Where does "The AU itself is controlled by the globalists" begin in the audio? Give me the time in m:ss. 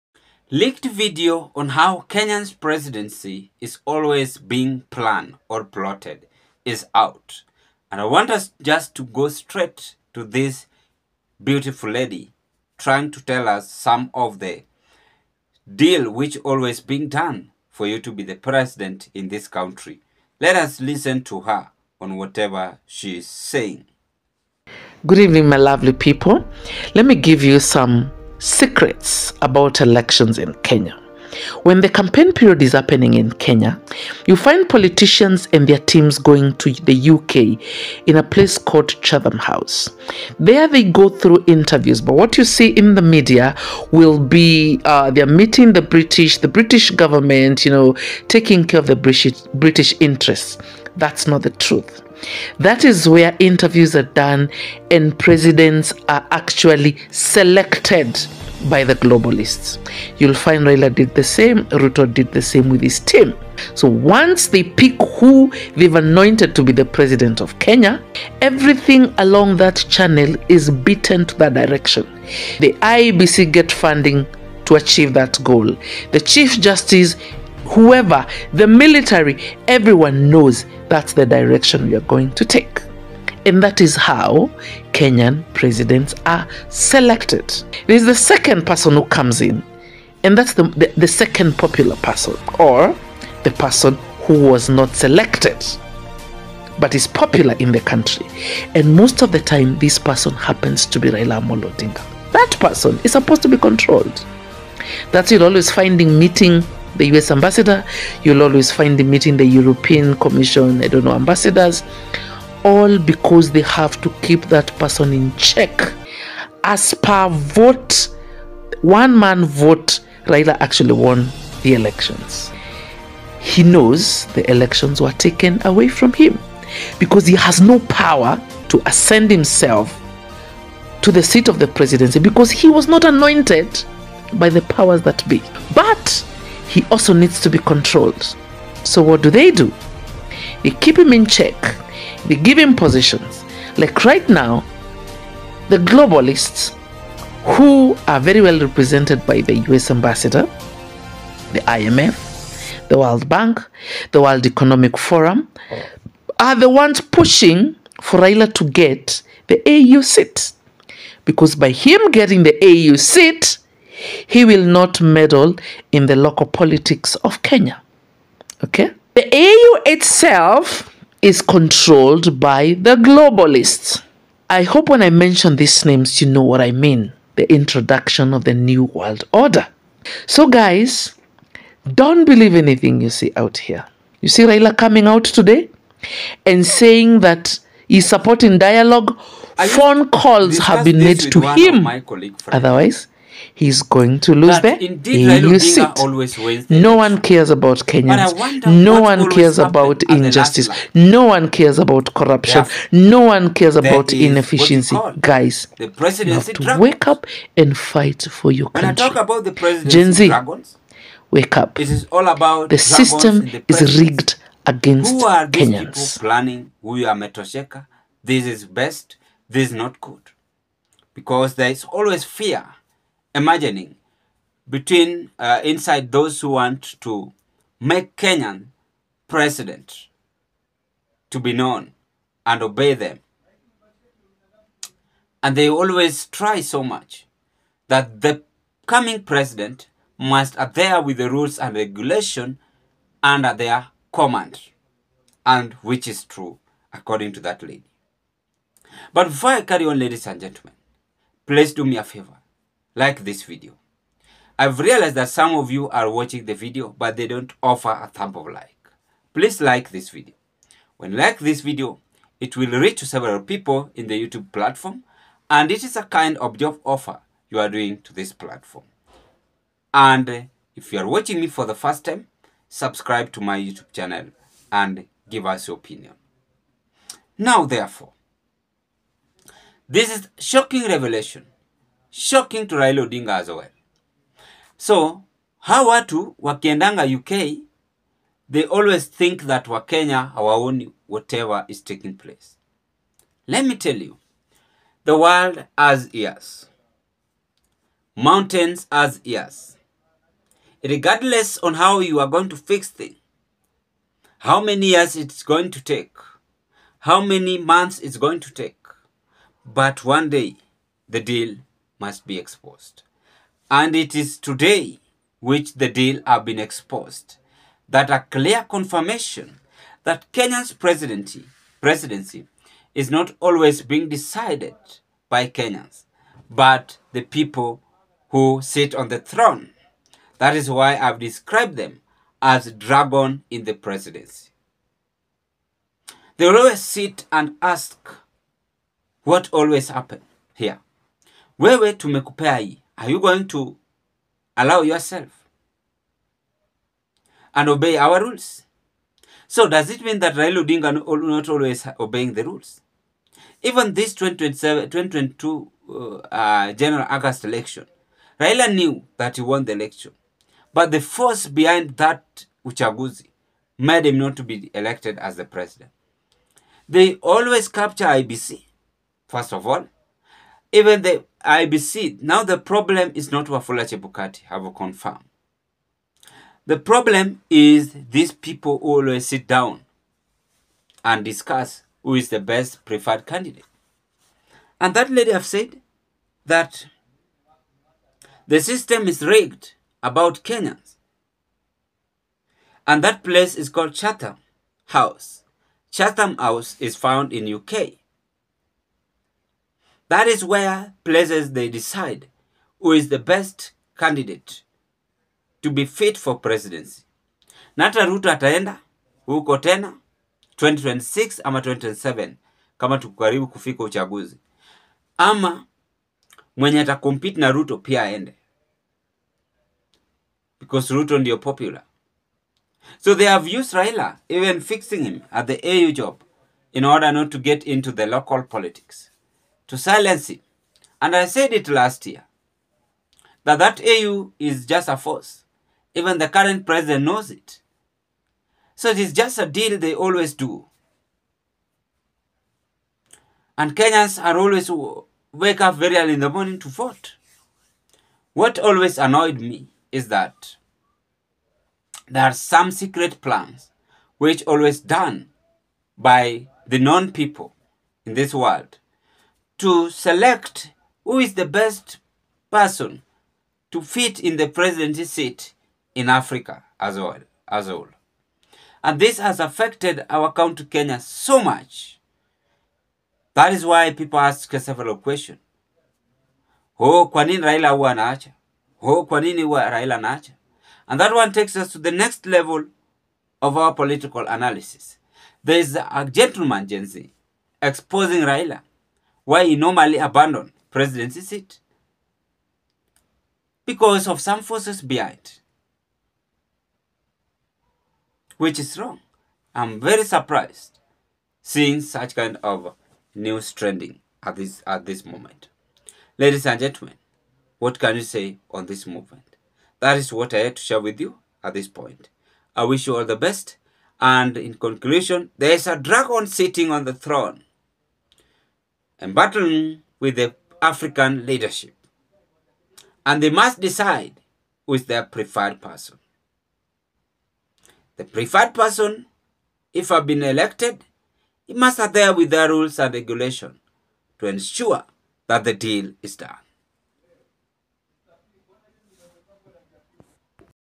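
2:49.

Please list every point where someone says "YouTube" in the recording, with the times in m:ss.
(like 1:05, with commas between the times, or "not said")
4:24, 4:33.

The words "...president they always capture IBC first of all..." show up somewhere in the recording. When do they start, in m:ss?
6:05.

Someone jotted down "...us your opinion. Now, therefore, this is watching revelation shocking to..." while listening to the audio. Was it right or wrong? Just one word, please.
wrong.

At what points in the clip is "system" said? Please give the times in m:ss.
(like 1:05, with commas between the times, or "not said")
3:32, 6:28.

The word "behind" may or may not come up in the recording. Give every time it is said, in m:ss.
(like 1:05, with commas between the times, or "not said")
6:01, 8:14.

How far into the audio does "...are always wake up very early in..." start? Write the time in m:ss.
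7:24.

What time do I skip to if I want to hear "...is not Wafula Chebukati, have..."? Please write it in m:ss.
6:13.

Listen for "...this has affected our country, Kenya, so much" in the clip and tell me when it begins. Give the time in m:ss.
7:48.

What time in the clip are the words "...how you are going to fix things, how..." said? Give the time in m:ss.
5:01.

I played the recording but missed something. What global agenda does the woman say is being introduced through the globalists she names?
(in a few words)
New World Order.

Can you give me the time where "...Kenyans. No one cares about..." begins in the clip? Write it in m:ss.
3:17.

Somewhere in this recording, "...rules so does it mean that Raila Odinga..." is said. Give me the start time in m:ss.
5:48.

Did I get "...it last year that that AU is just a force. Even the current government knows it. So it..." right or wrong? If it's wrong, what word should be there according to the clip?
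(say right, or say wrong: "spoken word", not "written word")
wrong: "president", not "government".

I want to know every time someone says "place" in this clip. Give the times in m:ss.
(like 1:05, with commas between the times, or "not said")
0:38, 4:52, 6:33, 6:41.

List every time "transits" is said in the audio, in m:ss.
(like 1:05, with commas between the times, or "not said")
not said.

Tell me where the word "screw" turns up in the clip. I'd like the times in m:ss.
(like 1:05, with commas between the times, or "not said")
not said.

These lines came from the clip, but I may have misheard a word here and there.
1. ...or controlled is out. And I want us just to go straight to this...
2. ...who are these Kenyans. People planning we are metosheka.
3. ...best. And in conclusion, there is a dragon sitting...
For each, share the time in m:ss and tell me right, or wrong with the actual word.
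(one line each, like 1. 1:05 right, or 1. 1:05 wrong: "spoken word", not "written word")
1. 0:05 wrong: "plotted", not "controlled"
2. 3:35 right
3. 8:33 right.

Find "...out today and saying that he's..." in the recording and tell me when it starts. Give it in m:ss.
3:05.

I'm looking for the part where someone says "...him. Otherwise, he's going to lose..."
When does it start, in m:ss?
3:11.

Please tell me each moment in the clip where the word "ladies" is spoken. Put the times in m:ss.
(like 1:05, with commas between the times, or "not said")
4:09, 8:26.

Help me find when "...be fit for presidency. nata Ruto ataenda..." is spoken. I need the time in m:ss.
6:45.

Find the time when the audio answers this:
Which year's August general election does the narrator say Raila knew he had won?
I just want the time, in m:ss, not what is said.
5:54.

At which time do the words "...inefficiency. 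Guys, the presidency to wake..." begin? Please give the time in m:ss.
3:24.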